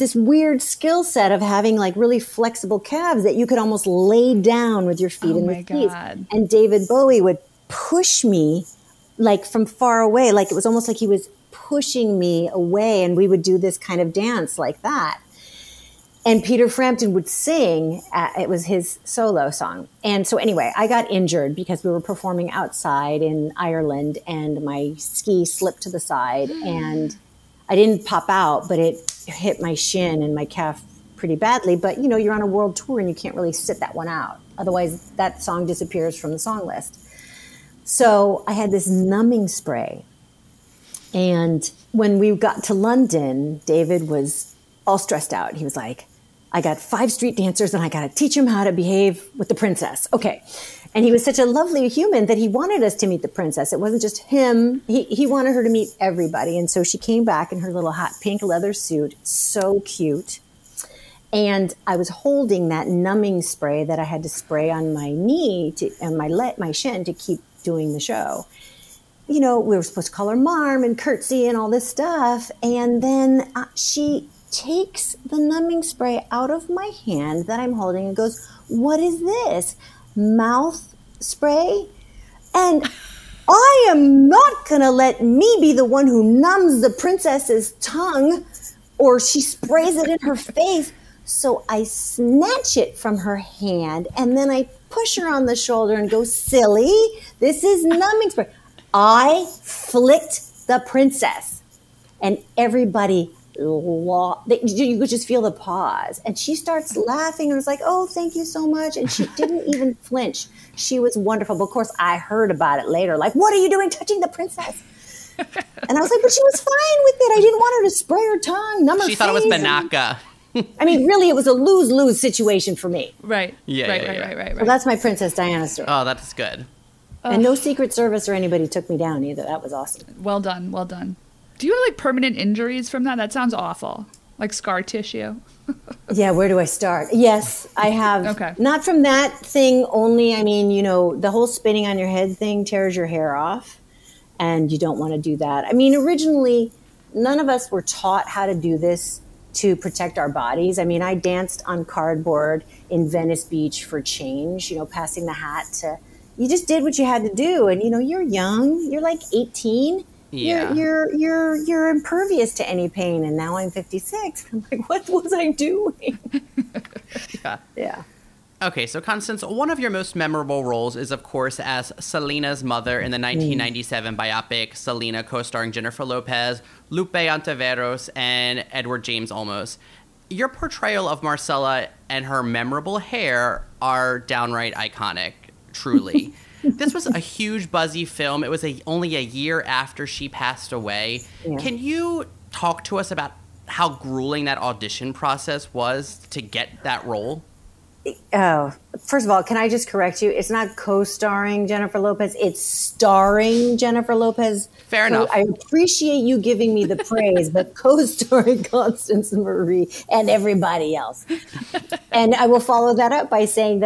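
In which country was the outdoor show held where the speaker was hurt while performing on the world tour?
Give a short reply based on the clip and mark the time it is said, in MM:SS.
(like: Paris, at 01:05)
Ireland, at 00:23.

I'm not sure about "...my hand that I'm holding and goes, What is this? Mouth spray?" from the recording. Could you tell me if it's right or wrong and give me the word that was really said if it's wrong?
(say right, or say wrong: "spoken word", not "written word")
right.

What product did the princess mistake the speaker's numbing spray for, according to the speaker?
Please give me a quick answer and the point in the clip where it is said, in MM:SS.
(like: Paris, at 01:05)
Binaca, at 01:59.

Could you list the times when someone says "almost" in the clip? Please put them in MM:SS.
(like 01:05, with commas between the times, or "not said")
00:03, 00:10.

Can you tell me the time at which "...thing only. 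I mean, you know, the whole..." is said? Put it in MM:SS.
02:19.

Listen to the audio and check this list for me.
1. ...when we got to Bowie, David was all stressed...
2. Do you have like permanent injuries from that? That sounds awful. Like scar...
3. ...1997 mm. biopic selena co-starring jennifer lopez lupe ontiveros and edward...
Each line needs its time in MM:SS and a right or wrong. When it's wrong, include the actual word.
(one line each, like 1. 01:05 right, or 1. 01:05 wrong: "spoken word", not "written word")
1. 00:41 wrong: "London", not "Bowie"
2. 02:11 right
3. 02:53 right.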